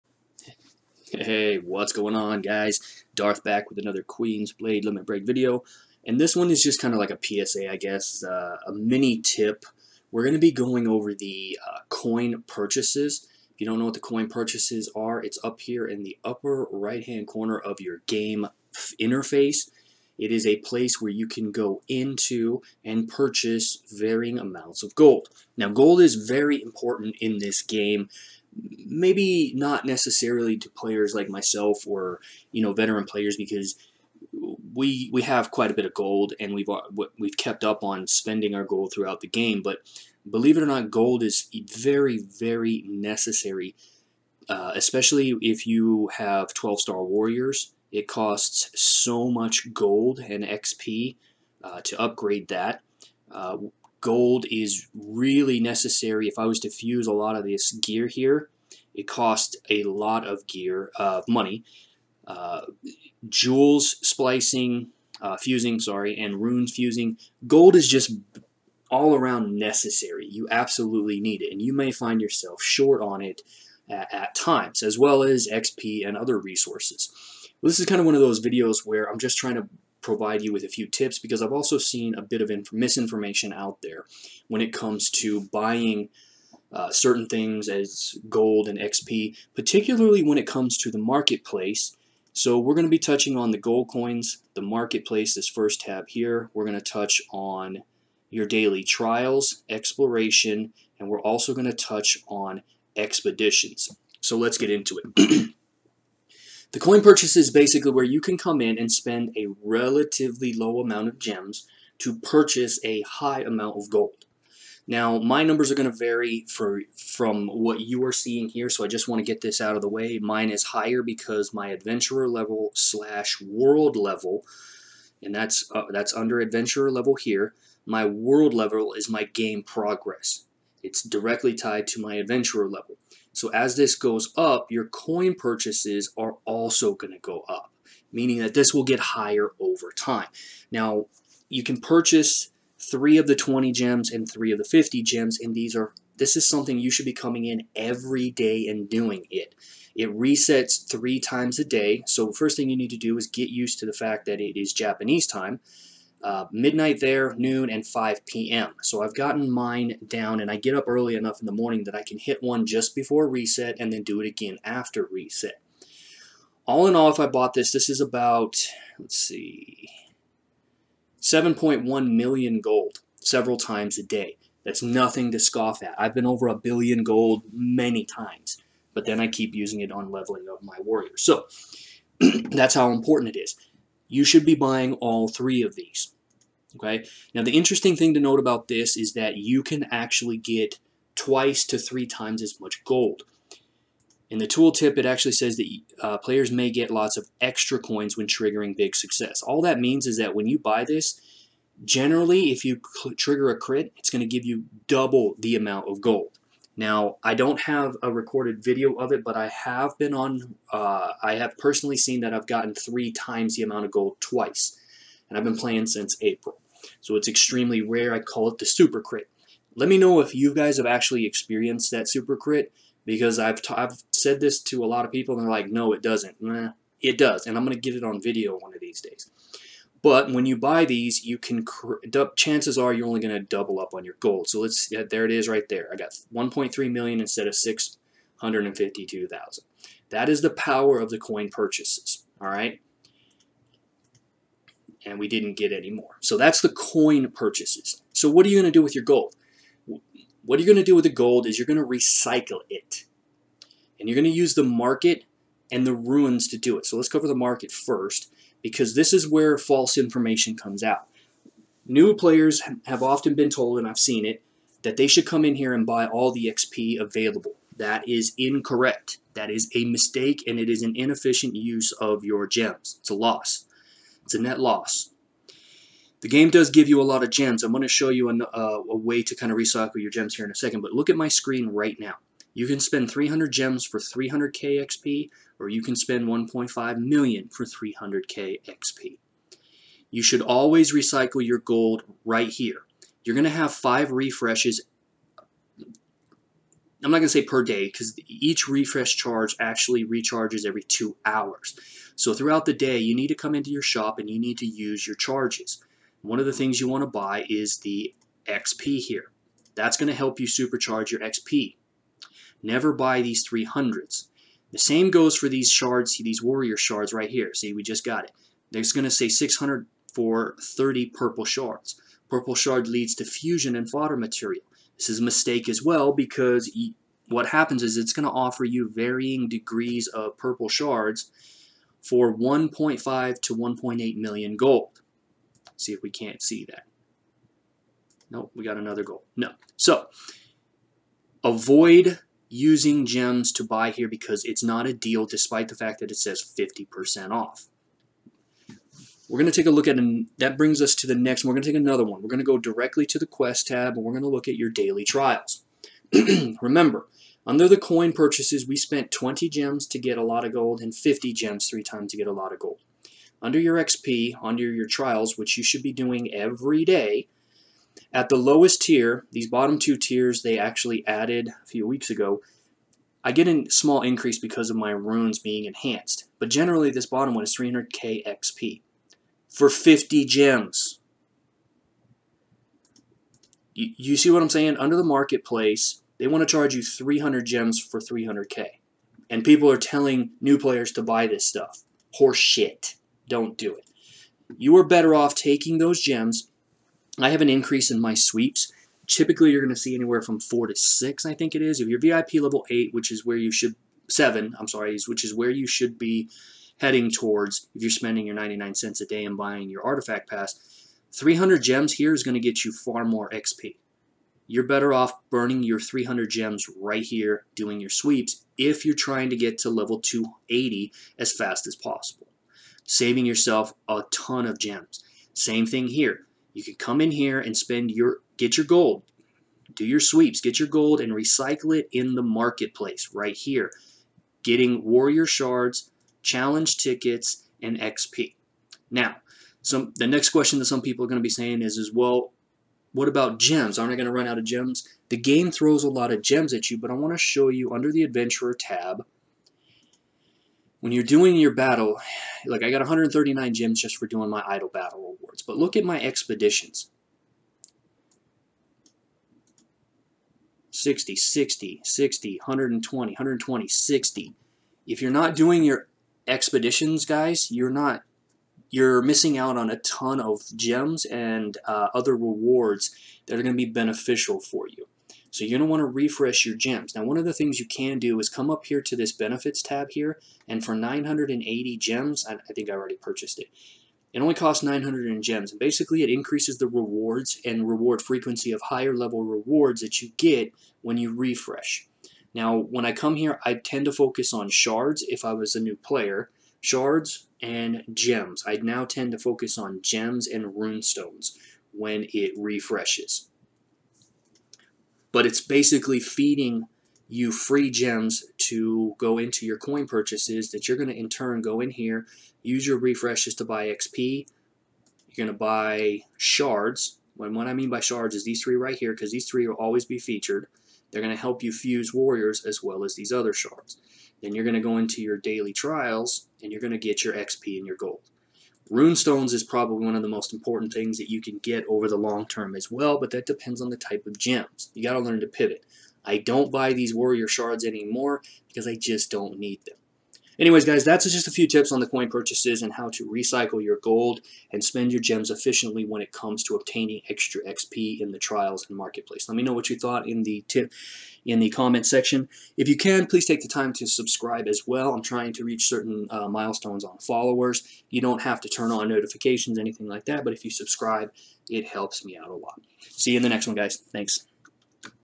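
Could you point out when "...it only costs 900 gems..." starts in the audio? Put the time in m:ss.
8:04.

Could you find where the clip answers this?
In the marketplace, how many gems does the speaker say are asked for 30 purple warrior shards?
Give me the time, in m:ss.
5:19.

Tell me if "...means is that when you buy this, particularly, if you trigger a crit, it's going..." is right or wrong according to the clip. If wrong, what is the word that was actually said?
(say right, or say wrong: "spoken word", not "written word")
wrong: "generally", not "particularly".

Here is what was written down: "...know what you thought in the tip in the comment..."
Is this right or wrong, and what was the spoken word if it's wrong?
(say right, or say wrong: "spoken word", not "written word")
right.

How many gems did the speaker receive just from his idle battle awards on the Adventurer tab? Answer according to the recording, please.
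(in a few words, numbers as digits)
139.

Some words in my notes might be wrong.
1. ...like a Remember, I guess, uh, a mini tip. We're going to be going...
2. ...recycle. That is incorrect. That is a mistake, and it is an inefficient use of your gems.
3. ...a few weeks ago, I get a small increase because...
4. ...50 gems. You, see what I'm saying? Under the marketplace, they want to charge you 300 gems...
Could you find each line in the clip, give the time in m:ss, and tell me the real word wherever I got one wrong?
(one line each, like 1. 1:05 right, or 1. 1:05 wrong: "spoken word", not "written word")
1. 0:07 wrong: "PSA", not "Remember"
2. 4:26 wrong: "available", not "recycle"
3. 6:11 right
4. 6:19 right.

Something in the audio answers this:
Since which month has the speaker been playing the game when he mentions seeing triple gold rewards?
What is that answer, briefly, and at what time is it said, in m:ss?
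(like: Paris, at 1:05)
April, at 3:36.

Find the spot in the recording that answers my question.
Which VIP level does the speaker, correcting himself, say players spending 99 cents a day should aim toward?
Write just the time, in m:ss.
6:44.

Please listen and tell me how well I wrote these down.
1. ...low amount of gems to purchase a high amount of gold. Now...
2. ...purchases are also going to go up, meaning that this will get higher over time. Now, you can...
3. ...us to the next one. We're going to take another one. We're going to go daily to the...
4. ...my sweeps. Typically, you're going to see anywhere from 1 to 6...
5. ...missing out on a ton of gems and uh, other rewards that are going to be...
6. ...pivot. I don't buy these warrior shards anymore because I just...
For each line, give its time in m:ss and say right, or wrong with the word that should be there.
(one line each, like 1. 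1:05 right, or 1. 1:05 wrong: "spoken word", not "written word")
1. 1:50 right
2. 2:15 right
3. 5:50 wrong: "directly", not "daily"
4. 6:38 wrong: "4", not "1"
5. 7:49 right
6. 8:55 right.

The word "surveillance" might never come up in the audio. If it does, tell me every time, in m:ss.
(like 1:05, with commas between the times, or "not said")
not said.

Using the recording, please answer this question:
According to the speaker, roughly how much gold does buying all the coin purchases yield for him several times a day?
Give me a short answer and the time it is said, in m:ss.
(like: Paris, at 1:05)
7.1 million, at 2:51.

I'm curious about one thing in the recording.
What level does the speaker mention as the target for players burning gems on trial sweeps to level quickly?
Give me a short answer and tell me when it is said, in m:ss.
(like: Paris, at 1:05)
280, at 6:59.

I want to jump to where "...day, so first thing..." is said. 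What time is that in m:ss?
2:31.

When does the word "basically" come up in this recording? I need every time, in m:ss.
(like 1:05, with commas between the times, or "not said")
1:47, 8:05, 8:25.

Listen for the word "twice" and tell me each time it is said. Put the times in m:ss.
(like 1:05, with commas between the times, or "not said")
3:11, 3:34.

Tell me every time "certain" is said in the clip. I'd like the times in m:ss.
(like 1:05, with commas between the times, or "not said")
1:26, 9:15.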